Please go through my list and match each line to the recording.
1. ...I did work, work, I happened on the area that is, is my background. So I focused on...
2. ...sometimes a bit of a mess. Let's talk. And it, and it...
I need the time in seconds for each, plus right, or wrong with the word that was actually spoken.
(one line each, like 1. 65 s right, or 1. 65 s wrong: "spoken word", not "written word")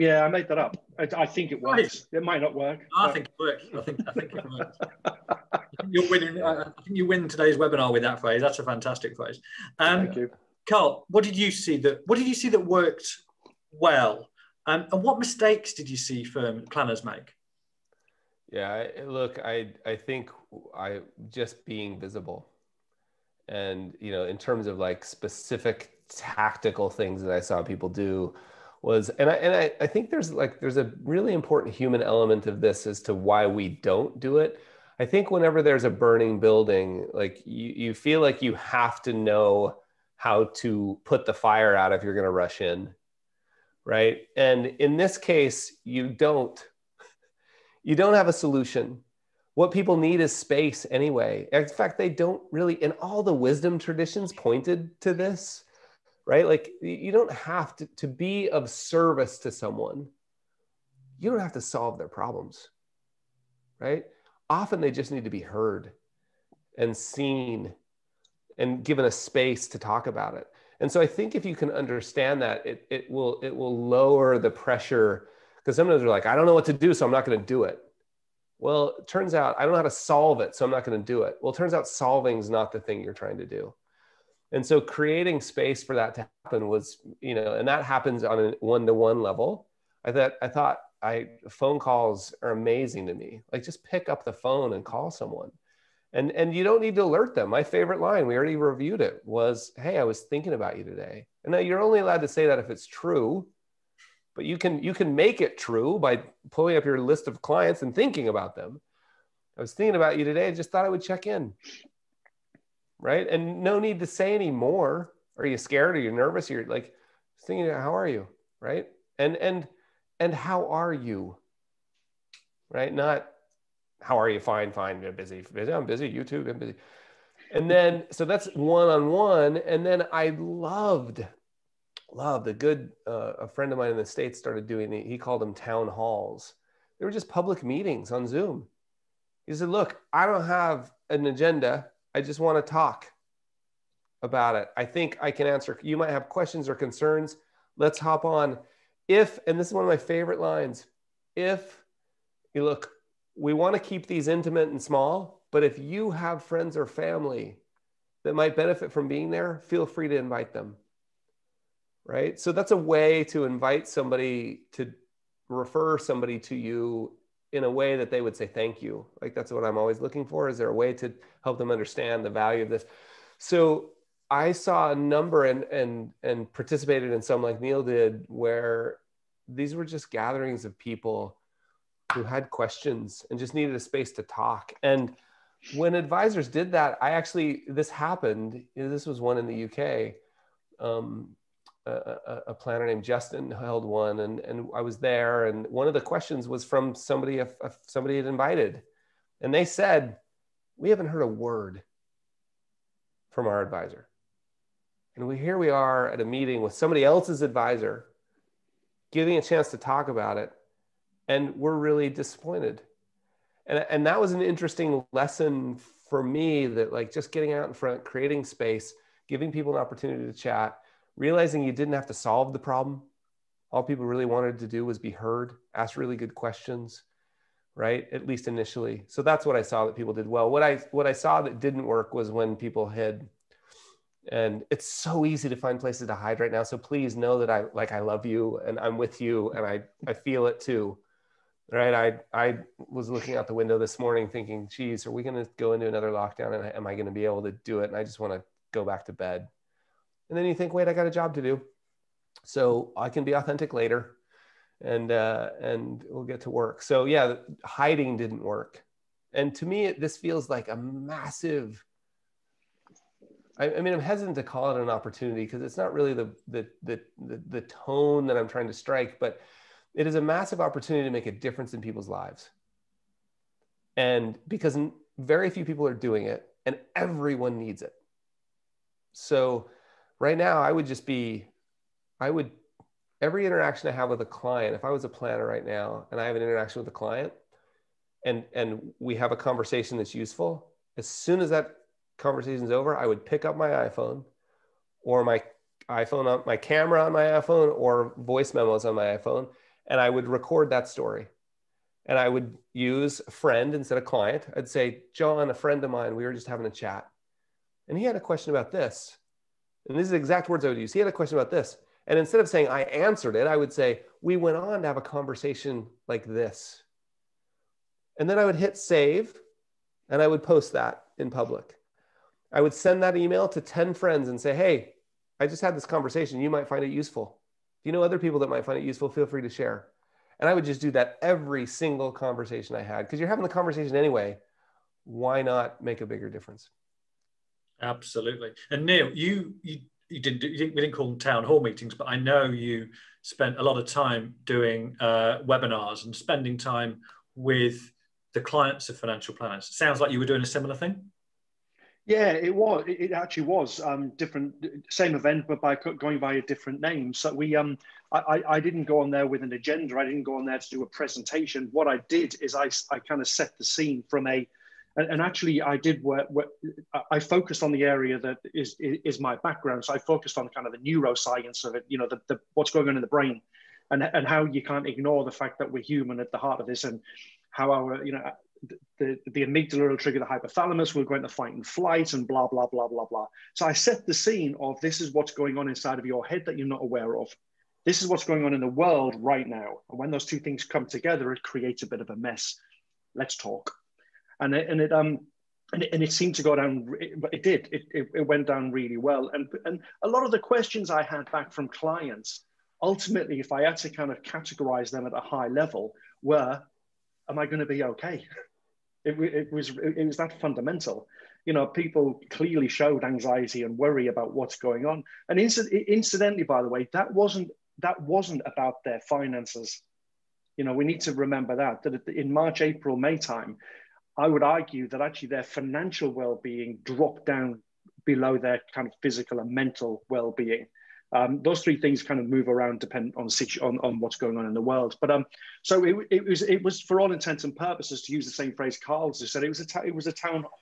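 1. 365 s wrong: "focused", not "happened"
2. 391 s wrong: "creates", not "sometimes".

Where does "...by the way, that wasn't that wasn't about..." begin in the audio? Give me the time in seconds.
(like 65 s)
416 s.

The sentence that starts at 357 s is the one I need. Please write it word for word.
So we, um, I, I didn't go on there with an agenda.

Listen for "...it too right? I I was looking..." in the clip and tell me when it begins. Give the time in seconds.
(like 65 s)
240 s.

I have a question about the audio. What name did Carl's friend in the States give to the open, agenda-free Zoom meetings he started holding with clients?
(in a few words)
town halls.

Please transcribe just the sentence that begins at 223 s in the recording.
All people really wanted to do was be heard, ask really good questions, right?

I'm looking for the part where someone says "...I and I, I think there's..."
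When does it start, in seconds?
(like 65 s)
29 s.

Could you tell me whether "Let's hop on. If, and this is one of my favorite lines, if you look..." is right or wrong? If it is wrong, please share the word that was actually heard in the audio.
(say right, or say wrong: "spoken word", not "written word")
right.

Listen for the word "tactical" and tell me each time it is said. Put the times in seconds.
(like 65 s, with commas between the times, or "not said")
26 s.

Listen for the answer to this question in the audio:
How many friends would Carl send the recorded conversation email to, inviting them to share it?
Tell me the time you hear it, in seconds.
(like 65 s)
323 s.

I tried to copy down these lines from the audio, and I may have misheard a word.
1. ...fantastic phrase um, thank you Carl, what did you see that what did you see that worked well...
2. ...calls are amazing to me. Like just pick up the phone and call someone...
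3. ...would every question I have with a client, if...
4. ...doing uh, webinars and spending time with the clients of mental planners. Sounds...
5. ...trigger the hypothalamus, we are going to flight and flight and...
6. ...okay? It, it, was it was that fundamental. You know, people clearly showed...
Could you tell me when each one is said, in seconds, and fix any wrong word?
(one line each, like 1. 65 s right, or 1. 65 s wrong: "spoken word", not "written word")
1. 8 s right
2. 91 s right
3. 282 s wrong: "interaction", not "question"
4. 344 s wrong: "financial", not "mental"
5. 379 s wrong: "fight", not "flight"
6. 407 s right.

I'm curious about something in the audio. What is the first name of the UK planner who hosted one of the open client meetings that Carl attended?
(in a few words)
Justin.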